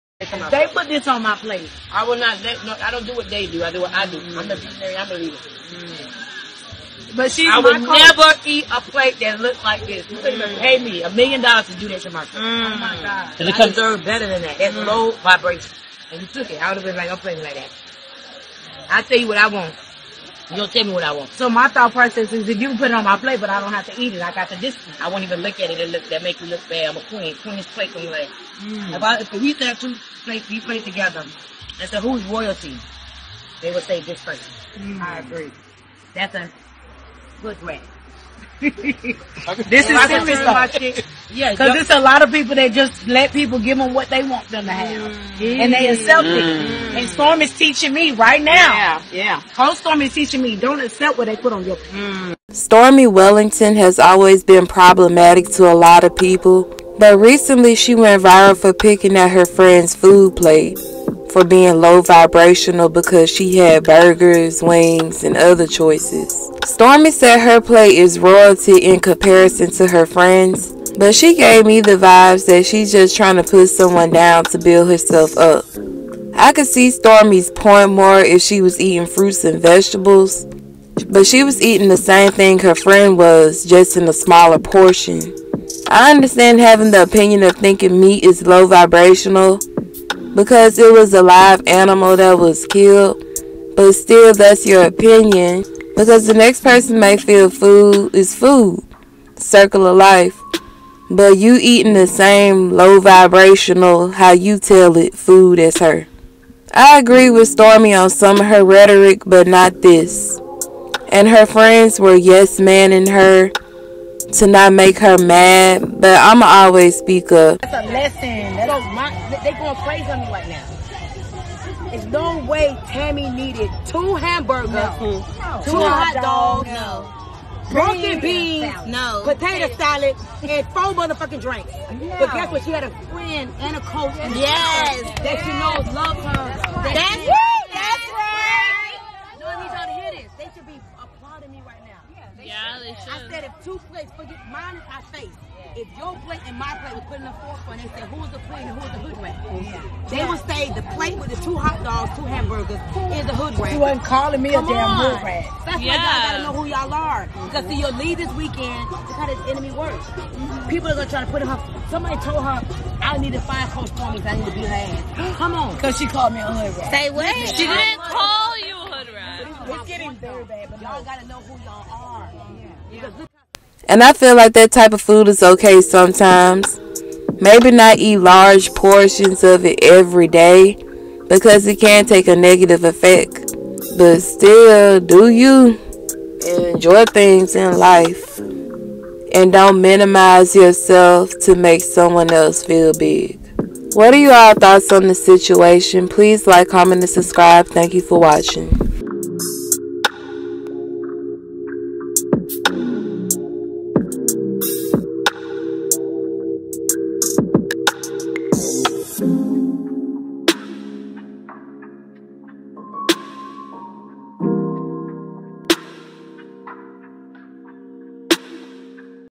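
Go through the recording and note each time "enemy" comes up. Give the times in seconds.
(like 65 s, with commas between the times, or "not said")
159 s.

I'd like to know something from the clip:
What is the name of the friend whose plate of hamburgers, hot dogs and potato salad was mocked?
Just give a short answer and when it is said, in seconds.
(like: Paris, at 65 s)
Tammy, at 122 s.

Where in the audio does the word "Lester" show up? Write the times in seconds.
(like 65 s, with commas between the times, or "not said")
not said.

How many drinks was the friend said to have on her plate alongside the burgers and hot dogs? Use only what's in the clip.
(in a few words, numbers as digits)
4.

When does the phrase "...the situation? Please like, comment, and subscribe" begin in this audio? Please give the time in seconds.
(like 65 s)
195 s.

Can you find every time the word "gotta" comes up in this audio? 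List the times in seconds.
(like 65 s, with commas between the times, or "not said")
156 s, 171 s.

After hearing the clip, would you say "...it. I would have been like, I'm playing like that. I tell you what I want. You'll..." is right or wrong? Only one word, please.
right.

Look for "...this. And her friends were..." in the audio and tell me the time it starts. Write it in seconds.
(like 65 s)
109 s.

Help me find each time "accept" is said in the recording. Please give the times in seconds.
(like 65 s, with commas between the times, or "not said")
45 s, 50 s.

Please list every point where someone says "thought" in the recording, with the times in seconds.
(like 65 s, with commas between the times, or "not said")
21 s, 194 s.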